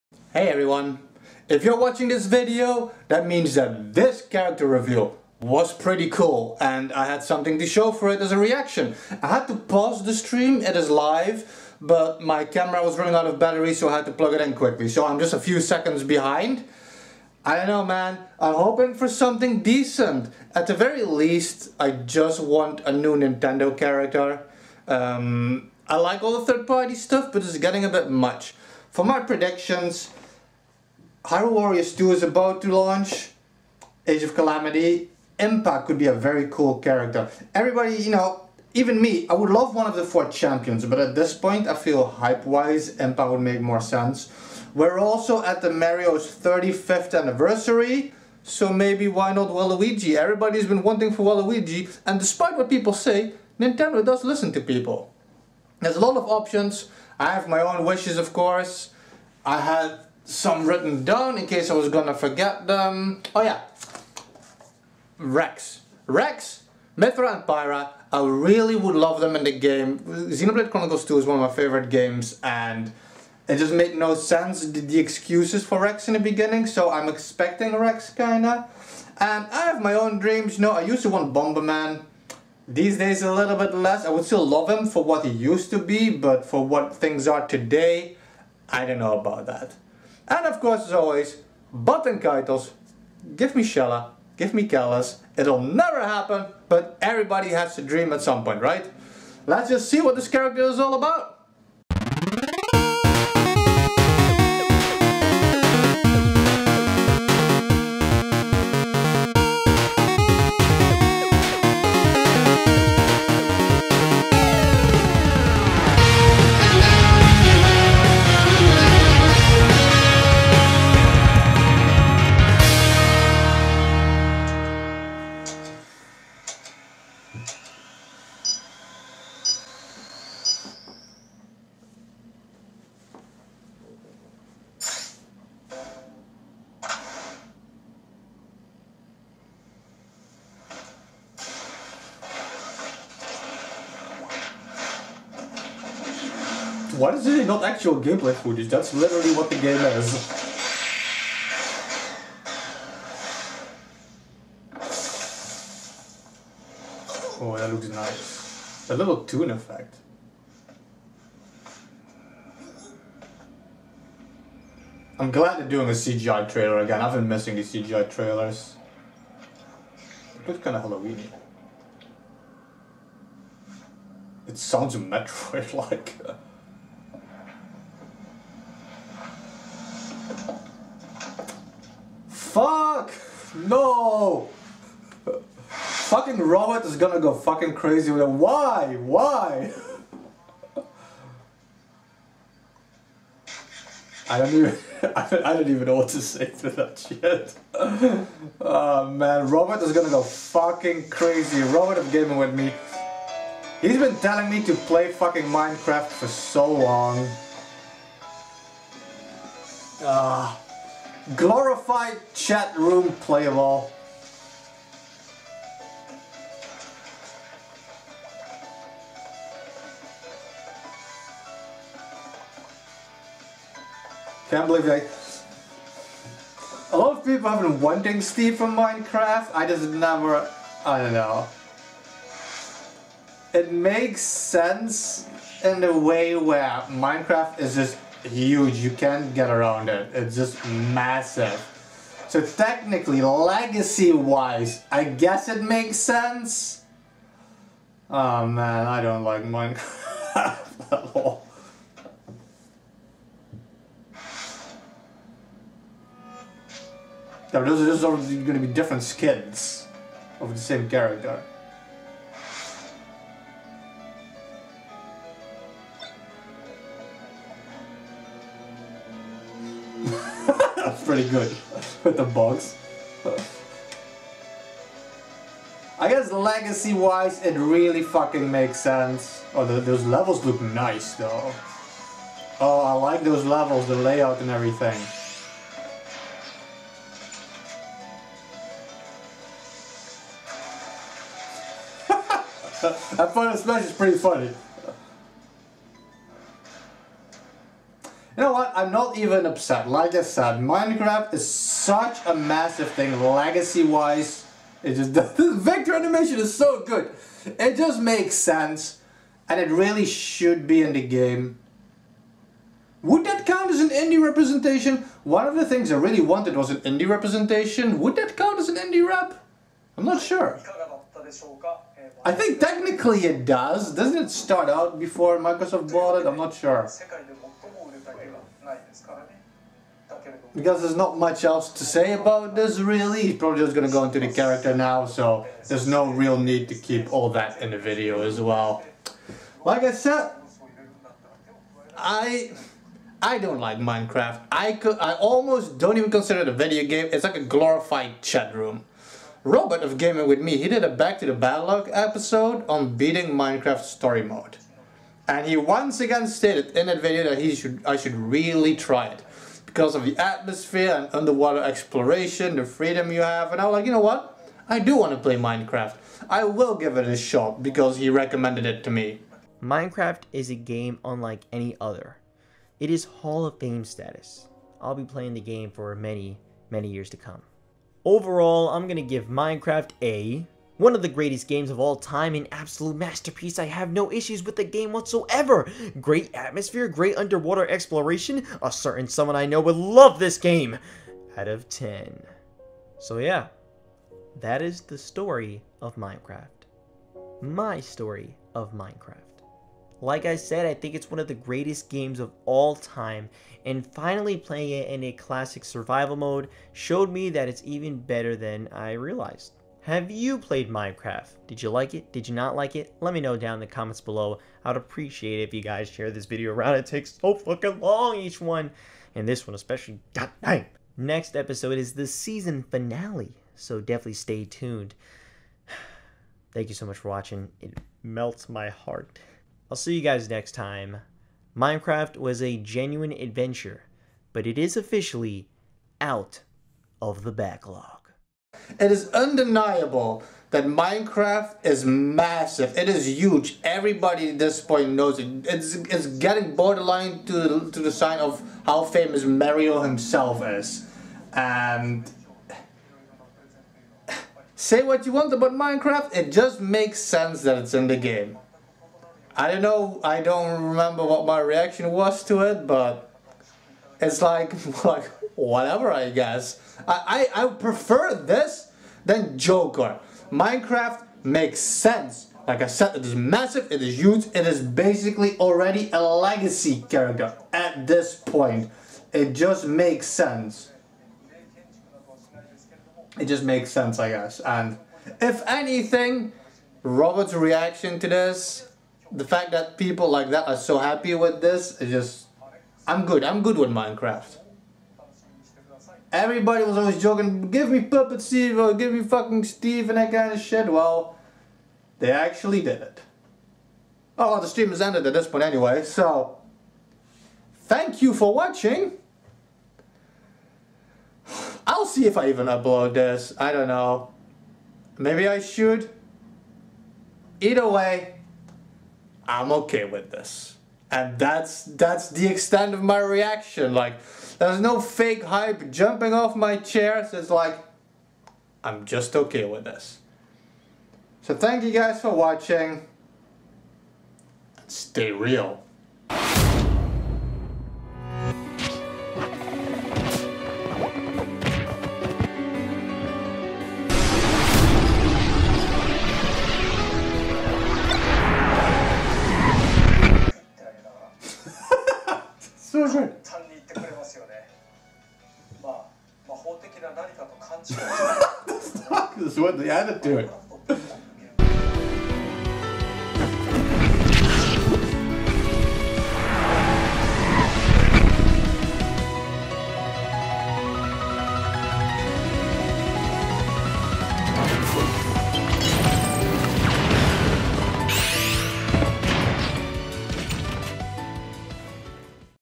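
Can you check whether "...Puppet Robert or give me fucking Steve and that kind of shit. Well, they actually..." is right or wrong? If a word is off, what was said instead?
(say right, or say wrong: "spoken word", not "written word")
wrong: "Steve", not "Robert".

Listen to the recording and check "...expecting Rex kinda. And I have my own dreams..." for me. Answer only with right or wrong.
right.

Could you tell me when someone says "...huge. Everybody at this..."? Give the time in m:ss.
7:23.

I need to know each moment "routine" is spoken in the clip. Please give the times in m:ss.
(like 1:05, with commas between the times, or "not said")
not said.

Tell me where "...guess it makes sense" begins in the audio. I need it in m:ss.
4:05.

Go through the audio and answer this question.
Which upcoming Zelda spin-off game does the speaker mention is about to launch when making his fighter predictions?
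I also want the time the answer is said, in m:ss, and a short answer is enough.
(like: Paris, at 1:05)
Age of Calamity, at 0:34.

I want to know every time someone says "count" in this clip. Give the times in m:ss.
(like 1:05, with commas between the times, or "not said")
5:13, 5:18.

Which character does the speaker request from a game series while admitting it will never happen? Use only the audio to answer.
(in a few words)
Xelha.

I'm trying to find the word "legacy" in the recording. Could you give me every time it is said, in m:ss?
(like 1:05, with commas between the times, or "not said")
4:03, 4:36, 5:03, 7:56.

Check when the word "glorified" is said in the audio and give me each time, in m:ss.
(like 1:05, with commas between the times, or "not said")
3:31, 5:47.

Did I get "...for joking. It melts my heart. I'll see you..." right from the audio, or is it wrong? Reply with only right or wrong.
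wrong.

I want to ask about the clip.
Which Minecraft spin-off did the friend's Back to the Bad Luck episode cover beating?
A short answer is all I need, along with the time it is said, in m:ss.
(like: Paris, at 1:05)
Minecraft Story Mode, at 5:53.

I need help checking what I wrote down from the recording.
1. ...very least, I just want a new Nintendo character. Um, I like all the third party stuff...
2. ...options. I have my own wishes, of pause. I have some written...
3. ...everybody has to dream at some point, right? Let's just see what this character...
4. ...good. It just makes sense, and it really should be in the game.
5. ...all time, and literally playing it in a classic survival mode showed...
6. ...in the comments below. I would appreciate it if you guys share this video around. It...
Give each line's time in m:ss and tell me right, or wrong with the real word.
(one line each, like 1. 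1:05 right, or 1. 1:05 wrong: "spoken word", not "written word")
1. 0:20 right
2. 0:56 wrong: "course", not "pause"
3. 1:37 right
4. 5:06 right
5. 6:42 wrong: "finally", not "literally"
6. 6:53 right.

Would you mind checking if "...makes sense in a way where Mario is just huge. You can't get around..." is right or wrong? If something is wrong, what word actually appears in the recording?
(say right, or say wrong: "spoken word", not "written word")
wrong: "Minecraft", not "Mario".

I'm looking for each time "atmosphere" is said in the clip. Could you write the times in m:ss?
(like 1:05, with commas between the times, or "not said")
6:00, 6:26.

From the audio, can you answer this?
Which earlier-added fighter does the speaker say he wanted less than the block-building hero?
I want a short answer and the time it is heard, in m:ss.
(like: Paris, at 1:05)
Joker, at 7:49.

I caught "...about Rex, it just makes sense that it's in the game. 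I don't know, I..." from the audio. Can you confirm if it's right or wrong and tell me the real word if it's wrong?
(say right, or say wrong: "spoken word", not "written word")
wrong: "Minecraft", not "Rex".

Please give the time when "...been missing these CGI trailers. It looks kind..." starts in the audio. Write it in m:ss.
2:47.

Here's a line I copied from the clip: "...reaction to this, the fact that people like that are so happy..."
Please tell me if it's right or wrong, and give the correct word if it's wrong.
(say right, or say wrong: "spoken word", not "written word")
right.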